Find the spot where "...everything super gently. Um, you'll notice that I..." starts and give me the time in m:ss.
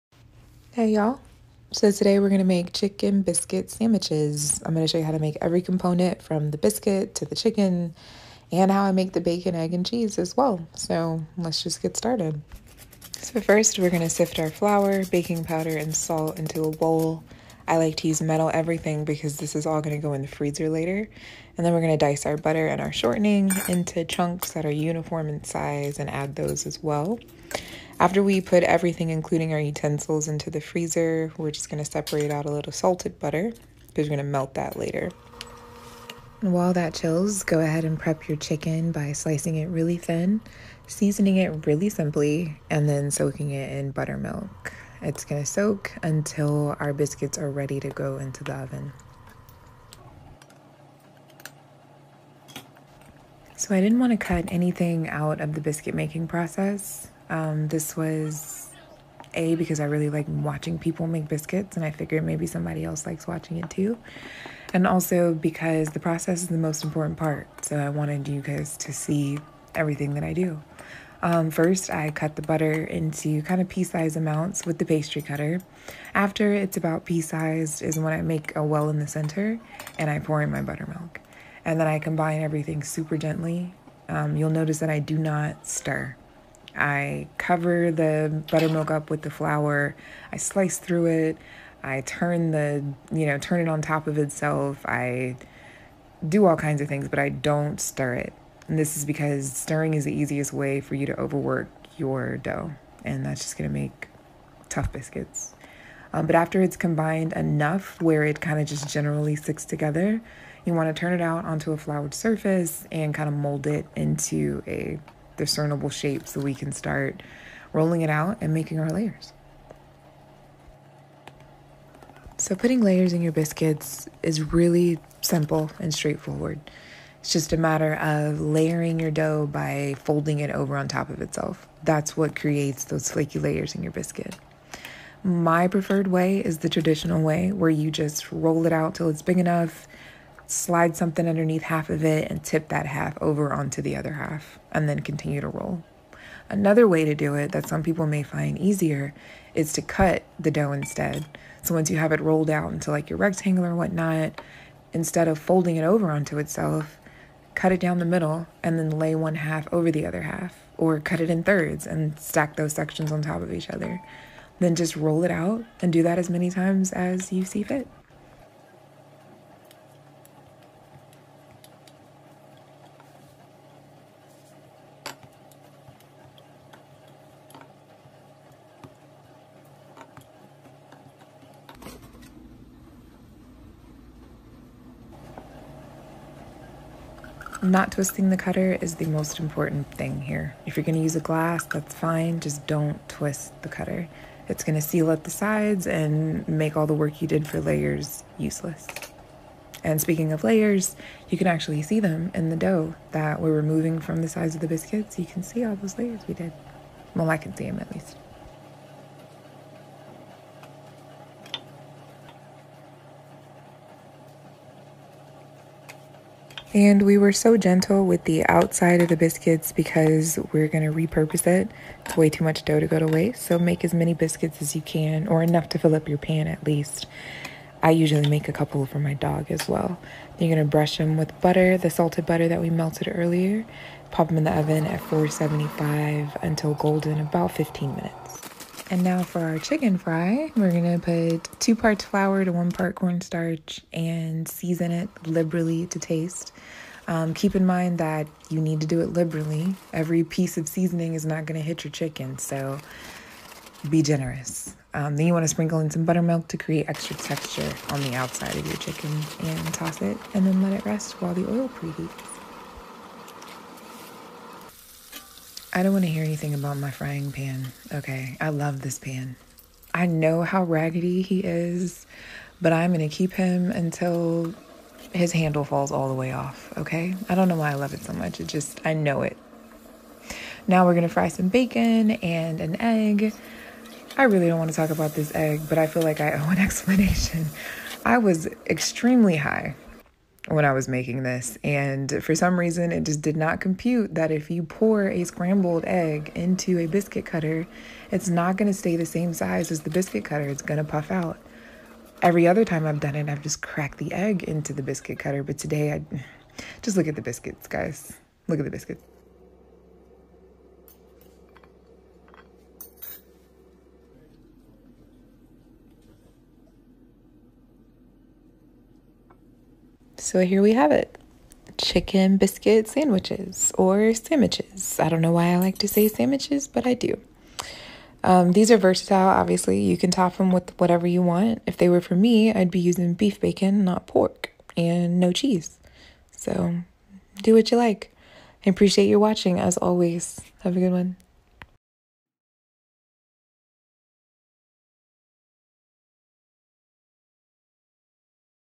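1:22.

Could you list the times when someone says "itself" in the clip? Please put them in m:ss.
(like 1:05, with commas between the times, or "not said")
1:34, 2:11, 2:36.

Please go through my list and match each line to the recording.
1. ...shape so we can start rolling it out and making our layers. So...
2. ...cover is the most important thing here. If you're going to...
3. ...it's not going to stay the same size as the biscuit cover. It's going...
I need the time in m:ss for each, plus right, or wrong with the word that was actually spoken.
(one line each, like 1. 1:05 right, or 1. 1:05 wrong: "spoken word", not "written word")
1. 1:55 right
2. 3:08 wrong: "cutter", not "cover"
3. 4:58 wrong: "cutter", not "cover".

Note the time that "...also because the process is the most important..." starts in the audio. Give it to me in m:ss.
1:04.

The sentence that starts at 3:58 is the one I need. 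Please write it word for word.
And now for our chicken fry, we're gonna put two parts flour to one part cornstarch and season it liberally to taste.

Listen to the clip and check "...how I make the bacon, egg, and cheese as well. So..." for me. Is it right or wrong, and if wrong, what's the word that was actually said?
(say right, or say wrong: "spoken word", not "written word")
right.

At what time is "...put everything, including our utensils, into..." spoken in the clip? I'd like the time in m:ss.
0:28.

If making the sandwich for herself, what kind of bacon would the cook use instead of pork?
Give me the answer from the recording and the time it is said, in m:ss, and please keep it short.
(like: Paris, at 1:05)
beef bacon, at 5:33.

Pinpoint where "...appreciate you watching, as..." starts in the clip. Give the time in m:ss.
5:38.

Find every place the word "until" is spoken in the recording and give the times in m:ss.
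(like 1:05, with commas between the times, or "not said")
0:46, 3:56, 4:33.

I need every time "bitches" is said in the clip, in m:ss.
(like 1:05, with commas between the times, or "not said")
not said.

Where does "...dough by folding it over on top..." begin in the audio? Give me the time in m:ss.
2:09.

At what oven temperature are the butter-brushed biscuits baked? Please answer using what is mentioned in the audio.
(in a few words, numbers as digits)
475.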